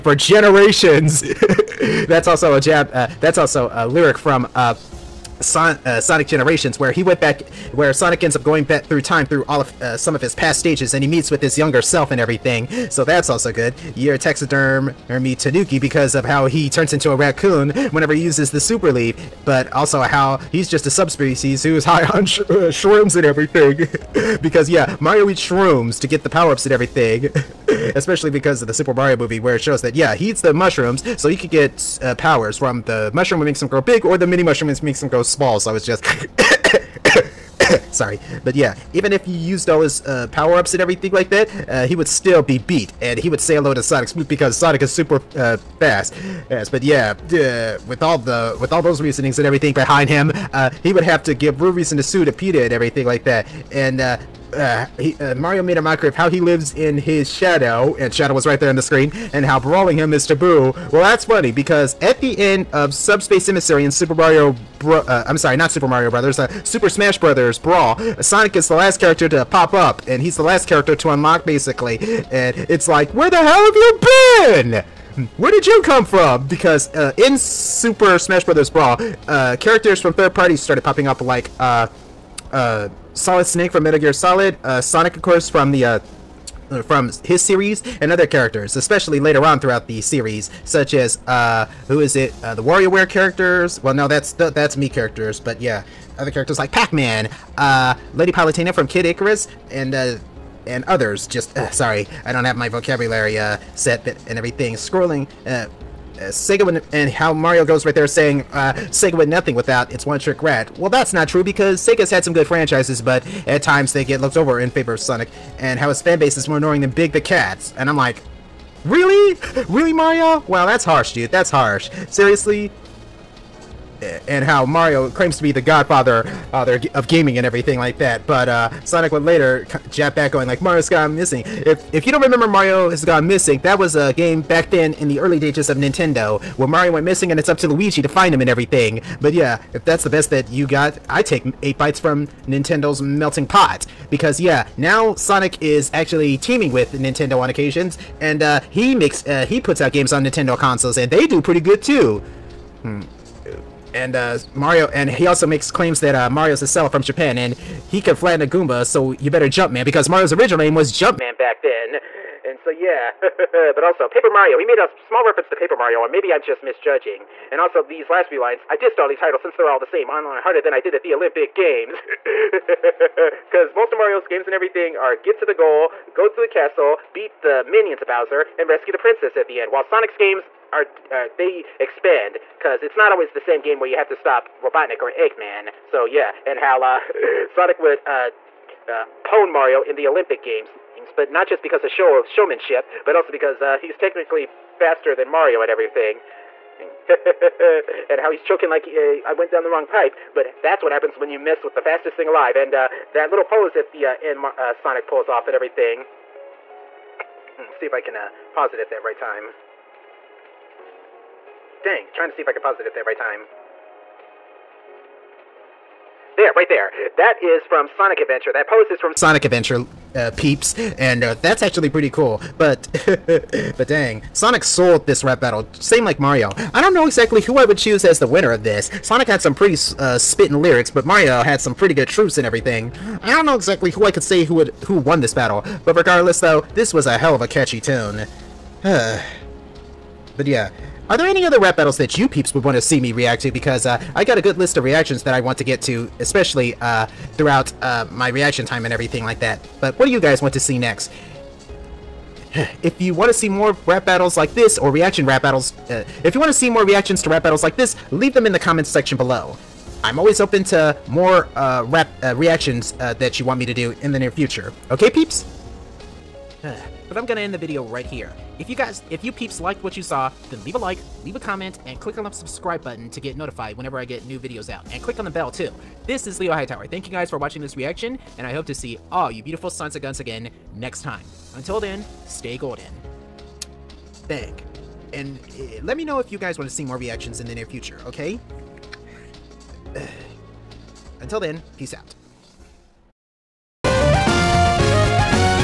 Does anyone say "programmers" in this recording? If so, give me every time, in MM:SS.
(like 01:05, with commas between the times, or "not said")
not said.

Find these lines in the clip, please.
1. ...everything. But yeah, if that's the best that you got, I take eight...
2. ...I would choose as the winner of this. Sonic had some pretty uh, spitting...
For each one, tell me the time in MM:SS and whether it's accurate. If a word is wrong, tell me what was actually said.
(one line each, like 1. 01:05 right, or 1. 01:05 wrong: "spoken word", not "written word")
1. 02:18 right
2. 03:47 right.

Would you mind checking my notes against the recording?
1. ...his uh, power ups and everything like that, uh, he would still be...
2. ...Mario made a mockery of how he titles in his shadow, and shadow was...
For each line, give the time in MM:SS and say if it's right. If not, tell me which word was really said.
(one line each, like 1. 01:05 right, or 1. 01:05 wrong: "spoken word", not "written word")
1. 00:39 right
2. 00:55 wrong: "lives", not "titles".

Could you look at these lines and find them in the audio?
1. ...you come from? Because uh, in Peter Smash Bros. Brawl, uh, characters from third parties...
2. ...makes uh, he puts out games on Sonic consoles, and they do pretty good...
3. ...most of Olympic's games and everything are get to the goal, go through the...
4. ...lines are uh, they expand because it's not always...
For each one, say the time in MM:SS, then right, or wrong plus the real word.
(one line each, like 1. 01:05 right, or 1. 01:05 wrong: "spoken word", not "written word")
1. 01:15 wrong: "Super", not "Peter"
2. 02:28 wrong: "Nintendo", not "Sonic"
3. 02:53 wrong: "Mario", not "Olympic"
4. 03:00 wrong: "games", not "lines".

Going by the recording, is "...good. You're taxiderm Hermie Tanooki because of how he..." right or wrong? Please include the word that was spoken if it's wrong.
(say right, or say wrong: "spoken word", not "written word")
right.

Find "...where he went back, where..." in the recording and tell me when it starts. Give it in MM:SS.
00:06.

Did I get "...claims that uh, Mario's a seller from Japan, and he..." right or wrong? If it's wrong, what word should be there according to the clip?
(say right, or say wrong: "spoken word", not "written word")
right.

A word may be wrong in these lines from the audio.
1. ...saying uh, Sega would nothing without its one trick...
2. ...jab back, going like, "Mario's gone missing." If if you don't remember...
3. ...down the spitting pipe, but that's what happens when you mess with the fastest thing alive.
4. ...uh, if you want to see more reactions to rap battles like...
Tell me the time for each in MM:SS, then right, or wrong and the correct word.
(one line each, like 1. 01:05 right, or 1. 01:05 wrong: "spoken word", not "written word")
1. 01:48 right
2. 02:09 right
3. 03:19 wrong: "wrong", not "spitting"
4. 04:15 right.